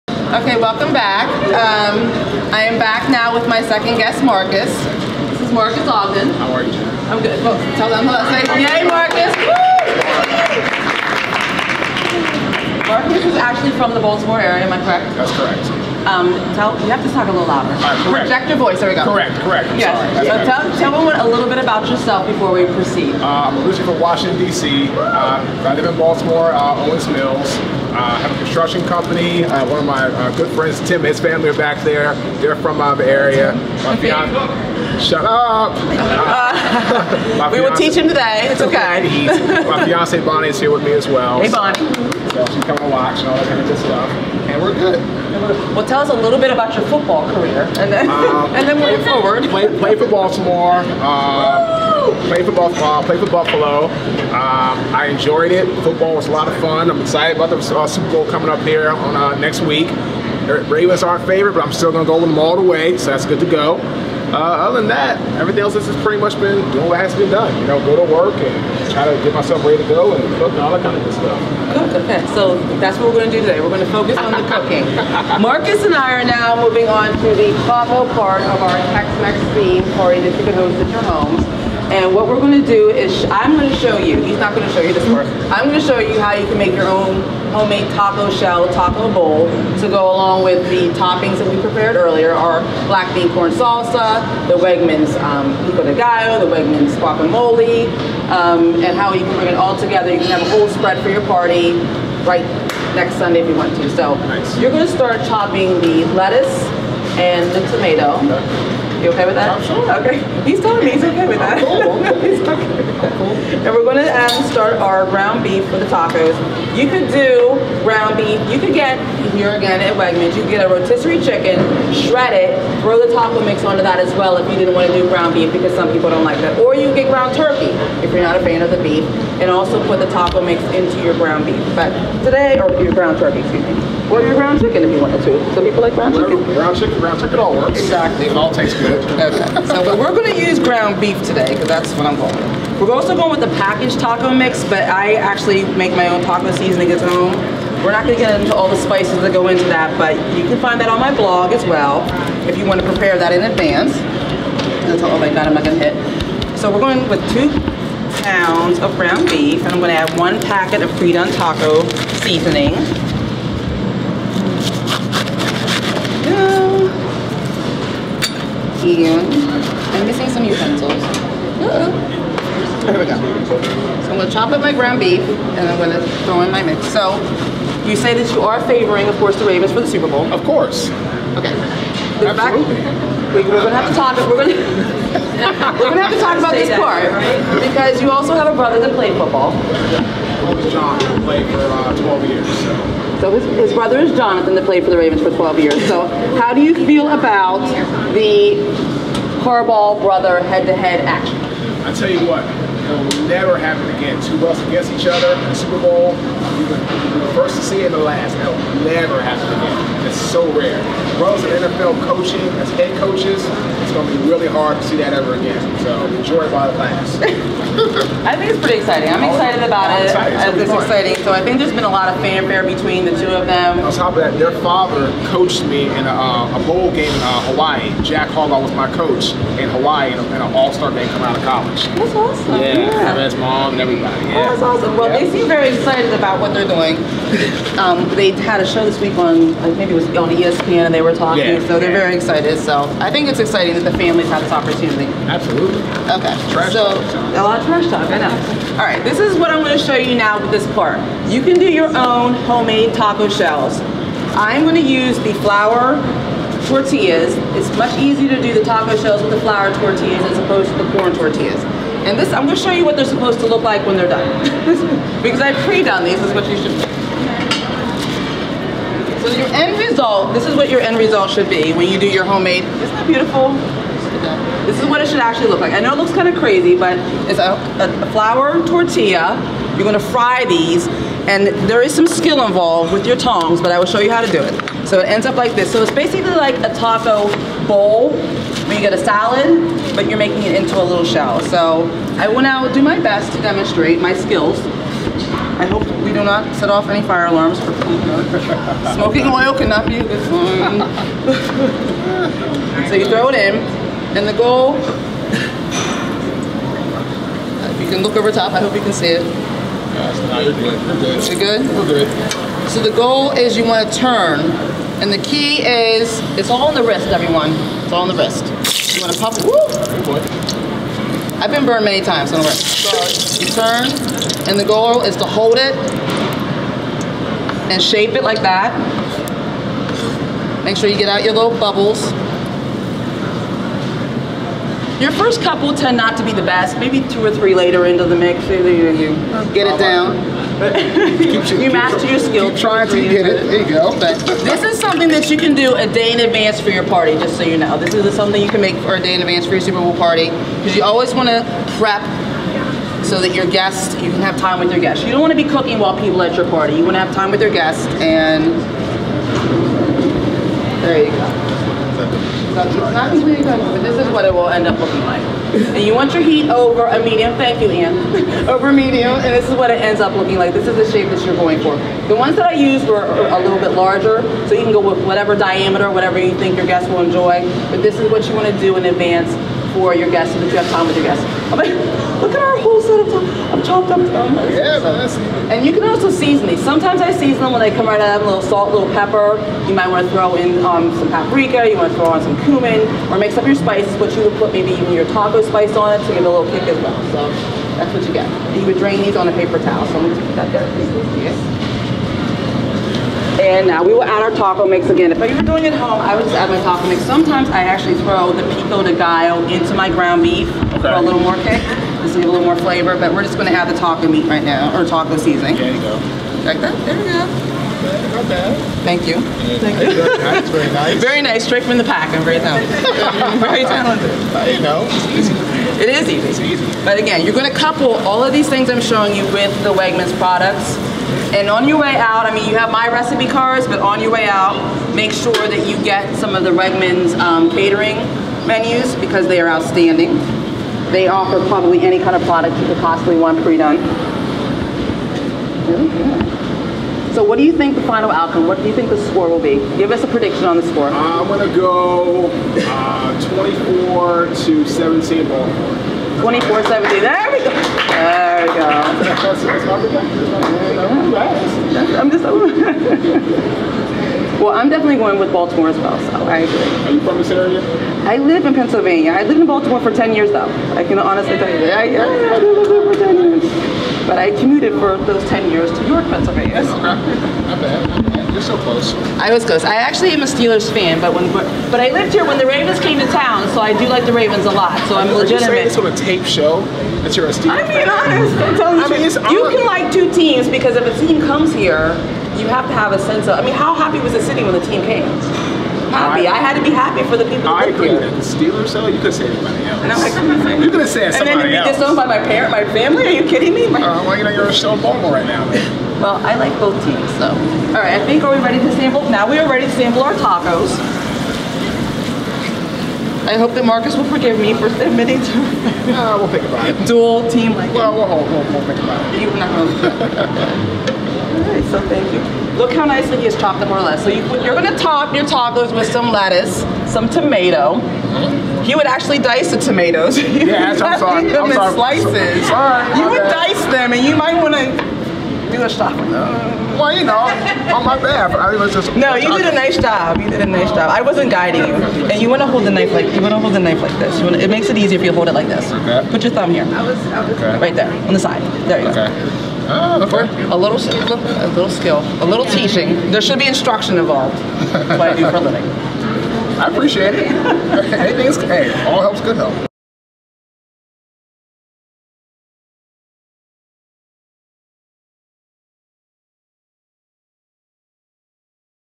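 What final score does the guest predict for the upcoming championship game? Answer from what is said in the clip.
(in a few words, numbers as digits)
24 to 17.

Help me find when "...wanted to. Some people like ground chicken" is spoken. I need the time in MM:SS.
02:14.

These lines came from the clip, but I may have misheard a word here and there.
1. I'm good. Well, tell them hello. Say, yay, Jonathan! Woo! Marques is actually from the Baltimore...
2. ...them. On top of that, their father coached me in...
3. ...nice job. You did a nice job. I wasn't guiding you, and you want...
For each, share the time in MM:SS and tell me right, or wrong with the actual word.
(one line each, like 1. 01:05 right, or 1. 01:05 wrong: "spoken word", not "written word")
1. 00:07 wrong: "Marques", not "Jonathan"
2. 03:43 right
3. 08:59 right.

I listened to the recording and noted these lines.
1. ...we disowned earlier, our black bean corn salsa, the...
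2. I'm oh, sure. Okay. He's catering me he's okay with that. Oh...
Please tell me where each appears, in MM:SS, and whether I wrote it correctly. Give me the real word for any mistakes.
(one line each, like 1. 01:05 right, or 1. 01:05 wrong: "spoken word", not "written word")
1. 01:31 wrong: "prepared", not "disowned"
2. 01:49 wrong: "telling", not "catering".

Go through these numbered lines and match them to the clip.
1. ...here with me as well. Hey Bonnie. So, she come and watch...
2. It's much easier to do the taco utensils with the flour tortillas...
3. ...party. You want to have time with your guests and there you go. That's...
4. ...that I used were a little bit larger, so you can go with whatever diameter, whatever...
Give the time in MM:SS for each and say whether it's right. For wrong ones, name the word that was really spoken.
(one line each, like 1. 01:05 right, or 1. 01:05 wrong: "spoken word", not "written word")
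1. 00:40 right
2. 04:17 wrong: "shells", not "utensils"
3. 05:56 right
4. 06:12 right.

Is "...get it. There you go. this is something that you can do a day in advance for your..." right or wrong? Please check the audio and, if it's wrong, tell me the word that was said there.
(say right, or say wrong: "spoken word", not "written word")
right.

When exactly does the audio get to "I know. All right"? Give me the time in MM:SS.
04:08.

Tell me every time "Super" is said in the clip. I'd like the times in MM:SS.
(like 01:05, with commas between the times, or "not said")
00:57, 02:59, 03:25, 05:49.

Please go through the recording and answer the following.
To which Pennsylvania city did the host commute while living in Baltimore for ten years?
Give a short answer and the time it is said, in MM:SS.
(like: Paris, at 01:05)
York, at 07:55.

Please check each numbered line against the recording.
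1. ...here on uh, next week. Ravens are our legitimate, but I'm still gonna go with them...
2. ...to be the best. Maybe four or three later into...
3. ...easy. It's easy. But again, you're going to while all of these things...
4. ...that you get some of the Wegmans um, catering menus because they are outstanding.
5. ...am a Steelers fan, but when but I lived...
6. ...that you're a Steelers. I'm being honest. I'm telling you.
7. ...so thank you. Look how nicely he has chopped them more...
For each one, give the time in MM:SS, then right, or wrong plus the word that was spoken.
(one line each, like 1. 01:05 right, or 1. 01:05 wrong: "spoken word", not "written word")
1. 00:58 wrong: "favorite", not "legitimate"
2. 05:36 wrong: "two", not "four"
3. 07:06 wrong: "couple", not "while"
4. 07:15 right
5. 08:00 right
6. 08:07 right
7. 08:41 right.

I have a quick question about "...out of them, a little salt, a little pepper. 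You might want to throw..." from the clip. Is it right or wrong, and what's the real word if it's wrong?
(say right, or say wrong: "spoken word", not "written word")
right.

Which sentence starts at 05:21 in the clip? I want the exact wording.
I've been burned many times, so don't worry.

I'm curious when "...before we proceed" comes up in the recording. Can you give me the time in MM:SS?
00:22.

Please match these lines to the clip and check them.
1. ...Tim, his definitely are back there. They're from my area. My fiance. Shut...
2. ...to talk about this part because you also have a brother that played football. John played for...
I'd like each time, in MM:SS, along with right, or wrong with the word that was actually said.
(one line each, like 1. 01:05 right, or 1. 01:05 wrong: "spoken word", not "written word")
1. 00:30 wrong: "family", not "definitely"
2. 03:06 right.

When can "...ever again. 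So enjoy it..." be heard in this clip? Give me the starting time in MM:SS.
03:35.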